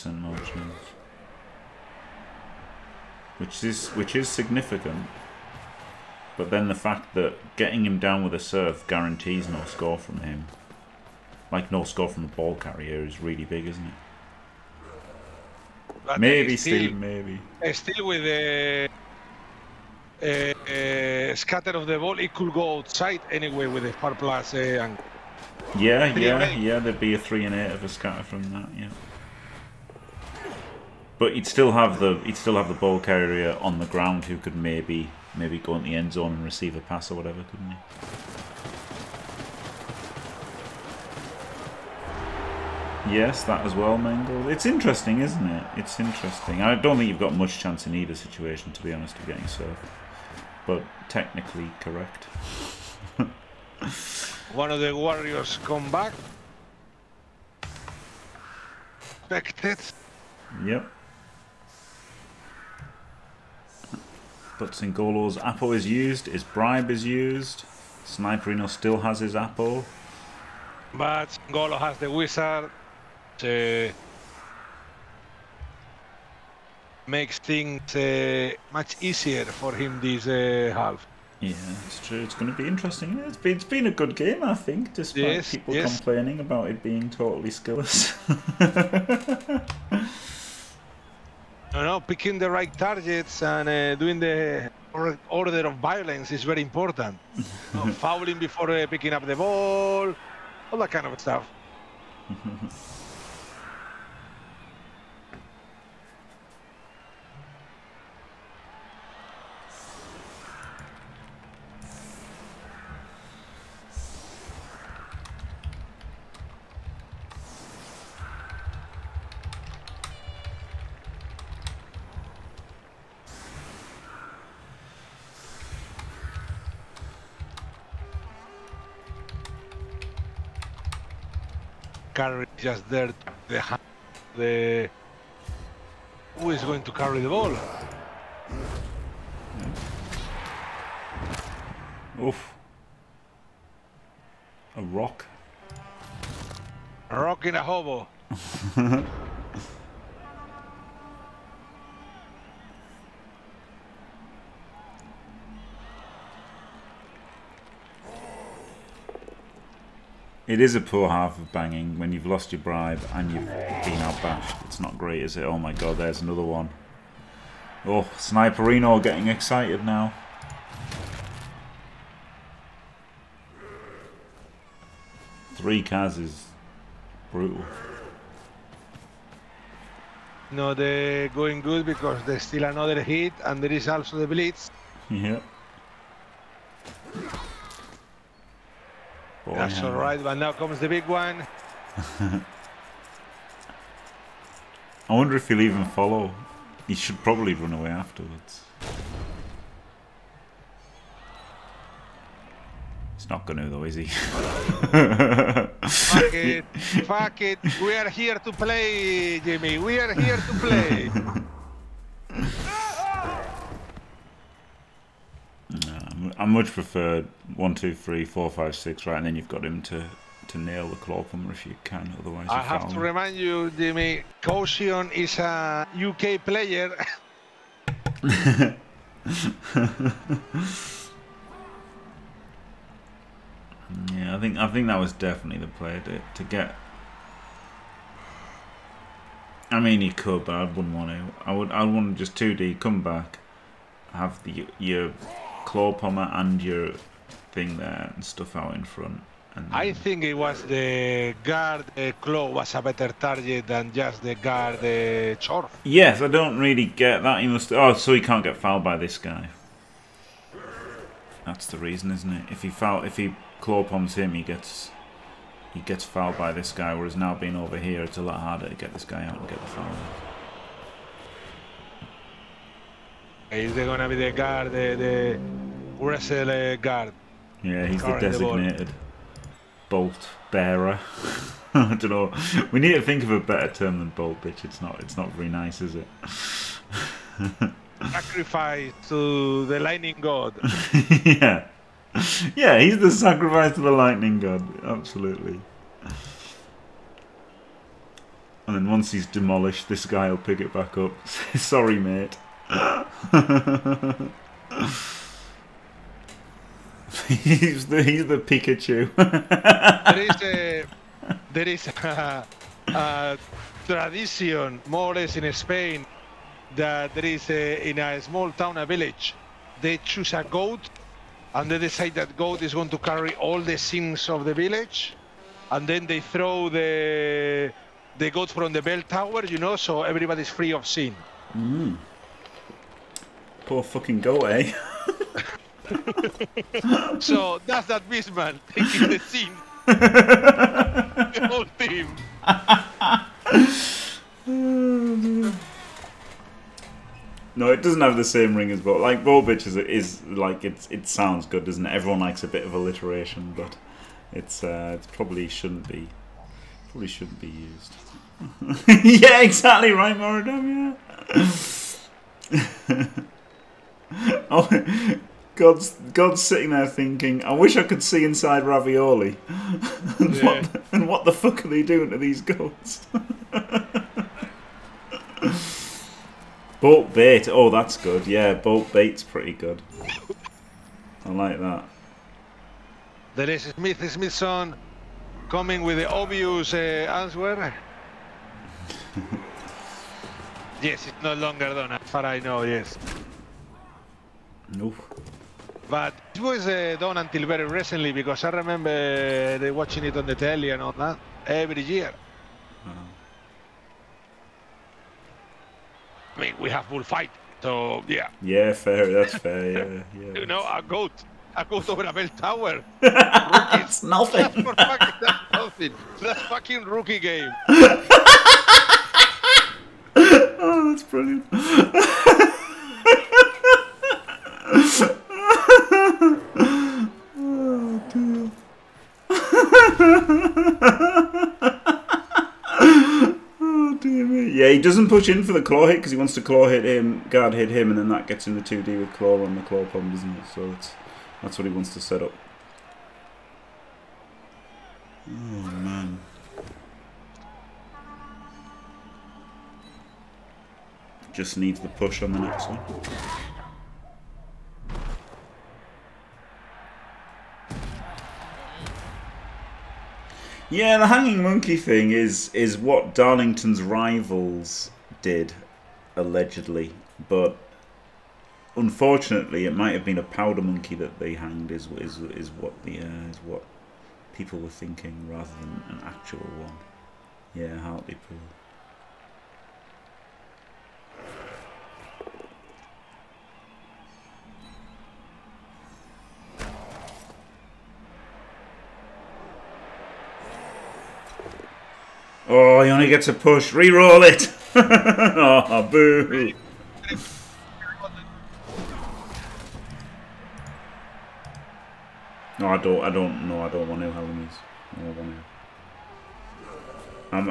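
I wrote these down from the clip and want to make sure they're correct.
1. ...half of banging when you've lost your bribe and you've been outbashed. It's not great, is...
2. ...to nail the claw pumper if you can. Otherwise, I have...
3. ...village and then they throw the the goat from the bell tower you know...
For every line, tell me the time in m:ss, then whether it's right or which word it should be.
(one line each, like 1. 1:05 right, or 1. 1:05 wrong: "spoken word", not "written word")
1. 2:41 right
2. 3:40 right
3. 5:24 right.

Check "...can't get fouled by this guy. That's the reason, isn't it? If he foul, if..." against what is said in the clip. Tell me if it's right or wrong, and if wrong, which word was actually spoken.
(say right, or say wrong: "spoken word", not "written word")
right.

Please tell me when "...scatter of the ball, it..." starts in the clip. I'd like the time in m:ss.
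0:21.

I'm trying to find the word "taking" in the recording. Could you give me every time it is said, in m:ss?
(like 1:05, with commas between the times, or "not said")
5:38.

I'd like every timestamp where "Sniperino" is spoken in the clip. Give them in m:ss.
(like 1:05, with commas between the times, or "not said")
1:08, 2:48.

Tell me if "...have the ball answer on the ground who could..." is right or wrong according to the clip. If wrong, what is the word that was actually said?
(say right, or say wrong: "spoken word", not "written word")
wrong: "carrier", not "answer".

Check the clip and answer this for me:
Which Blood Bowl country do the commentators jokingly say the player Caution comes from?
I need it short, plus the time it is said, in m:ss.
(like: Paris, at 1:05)
UK, at 3:45.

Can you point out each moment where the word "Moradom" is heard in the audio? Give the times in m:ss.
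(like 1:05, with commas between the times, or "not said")
6:00.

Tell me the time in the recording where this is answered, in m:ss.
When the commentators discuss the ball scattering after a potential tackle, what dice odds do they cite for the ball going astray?
0:27.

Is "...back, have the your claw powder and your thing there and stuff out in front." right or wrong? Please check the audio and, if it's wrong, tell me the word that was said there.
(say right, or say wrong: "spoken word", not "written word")
wrong: "pommer", not "powder".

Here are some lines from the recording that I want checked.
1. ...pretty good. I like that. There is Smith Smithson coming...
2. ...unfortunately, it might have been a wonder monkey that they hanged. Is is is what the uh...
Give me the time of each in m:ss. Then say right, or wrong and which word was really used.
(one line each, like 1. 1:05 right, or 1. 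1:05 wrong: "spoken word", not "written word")
1. 6:19 right
2. 7:48 wrong: "powder", not "wonder".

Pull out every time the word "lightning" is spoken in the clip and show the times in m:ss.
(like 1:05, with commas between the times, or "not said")
4:49, 4:53.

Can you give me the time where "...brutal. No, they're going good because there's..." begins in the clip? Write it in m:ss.
2:57.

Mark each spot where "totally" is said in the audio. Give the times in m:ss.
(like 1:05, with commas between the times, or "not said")
1:27.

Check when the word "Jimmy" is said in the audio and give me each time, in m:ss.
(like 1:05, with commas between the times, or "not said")
3:29, 3:43.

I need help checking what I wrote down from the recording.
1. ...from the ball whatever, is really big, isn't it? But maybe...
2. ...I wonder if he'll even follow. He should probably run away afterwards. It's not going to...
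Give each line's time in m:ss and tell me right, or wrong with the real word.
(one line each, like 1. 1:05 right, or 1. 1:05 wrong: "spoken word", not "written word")
1. 0:12 wrong: "carrier", not "whatever"
2. 3:15 right.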